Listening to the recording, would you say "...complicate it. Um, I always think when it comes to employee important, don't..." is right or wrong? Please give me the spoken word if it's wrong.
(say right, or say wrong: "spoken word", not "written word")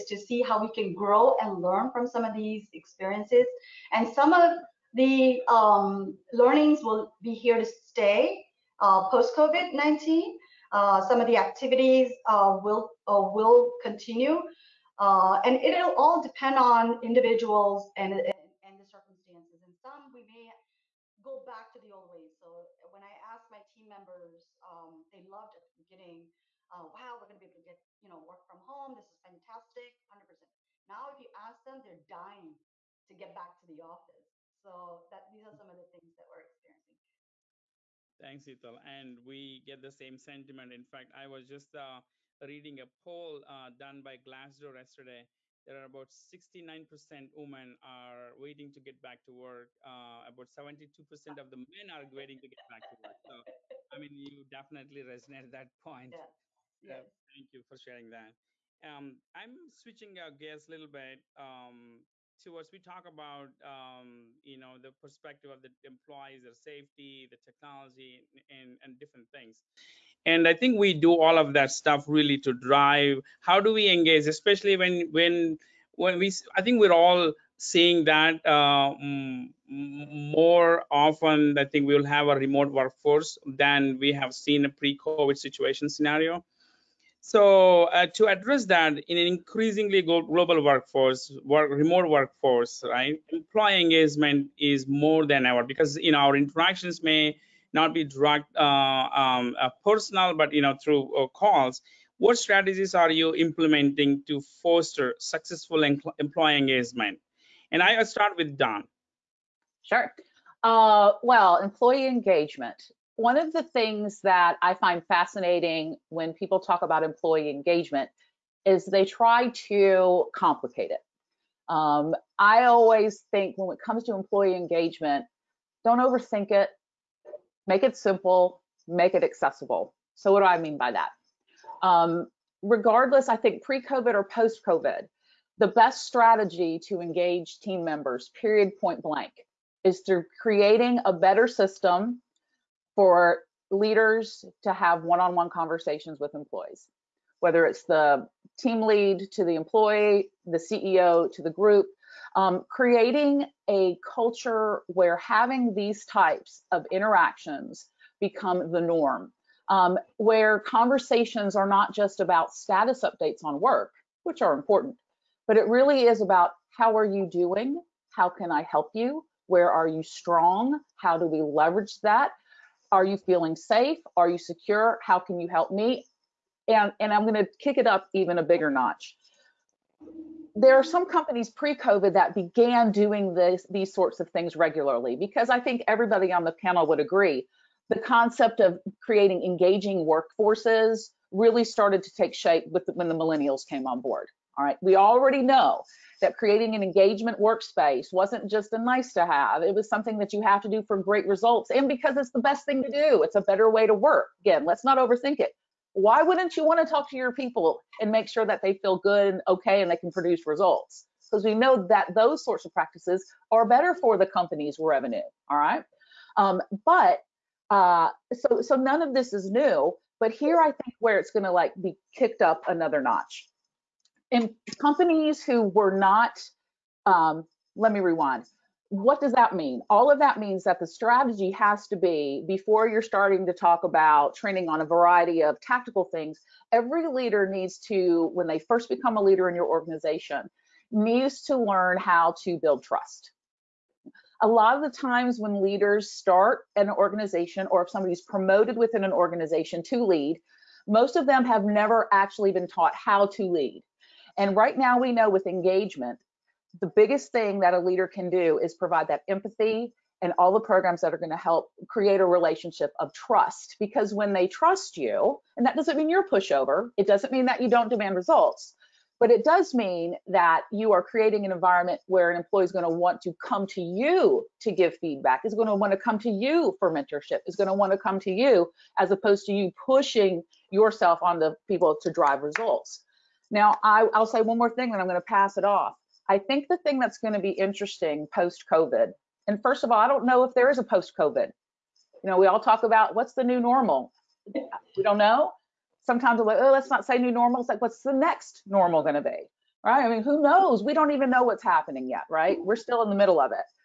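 wrong: "engagement", not "important".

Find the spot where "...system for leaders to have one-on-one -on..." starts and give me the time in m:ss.
2:21.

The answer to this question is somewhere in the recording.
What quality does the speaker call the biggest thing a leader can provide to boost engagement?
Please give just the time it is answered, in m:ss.
4:19.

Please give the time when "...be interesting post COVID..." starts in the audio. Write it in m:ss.
4:47.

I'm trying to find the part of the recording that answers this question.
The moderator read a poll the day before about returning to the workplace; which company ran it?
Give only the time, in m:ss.
0:44.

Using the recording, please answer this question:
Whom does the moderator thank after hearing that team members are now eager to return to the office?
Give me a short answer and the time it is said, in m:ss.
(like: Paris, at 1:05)
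Hetal, at 0:38.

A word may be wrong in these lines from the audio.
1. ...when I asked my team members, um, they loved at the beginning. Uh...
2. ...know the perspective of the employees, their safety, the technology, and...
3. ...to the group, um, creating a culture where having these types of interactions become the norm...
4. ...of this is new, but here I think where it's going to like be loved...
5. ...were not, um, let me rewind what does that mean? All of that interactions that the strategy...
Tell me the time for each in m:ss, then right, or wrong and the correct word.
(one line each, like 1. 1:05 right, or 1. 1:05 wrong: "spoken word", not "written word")
1. 0:22 right
2. 1:04 right
3. 2:31 right
4. 3:39 wrong: "kicked", not "loved"
5. 3:45 wrong: "means", not "interactions".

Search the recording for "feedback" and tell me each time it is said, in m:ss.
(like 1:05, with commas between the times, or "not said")
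4:34.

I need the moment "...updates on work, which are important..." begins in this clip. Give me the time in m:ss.
2:43.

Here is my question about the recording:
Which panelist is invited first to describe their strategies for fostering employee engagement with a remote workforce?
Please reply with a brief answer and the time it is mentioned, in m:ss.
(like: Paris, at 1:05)
Dawn, at 1:48.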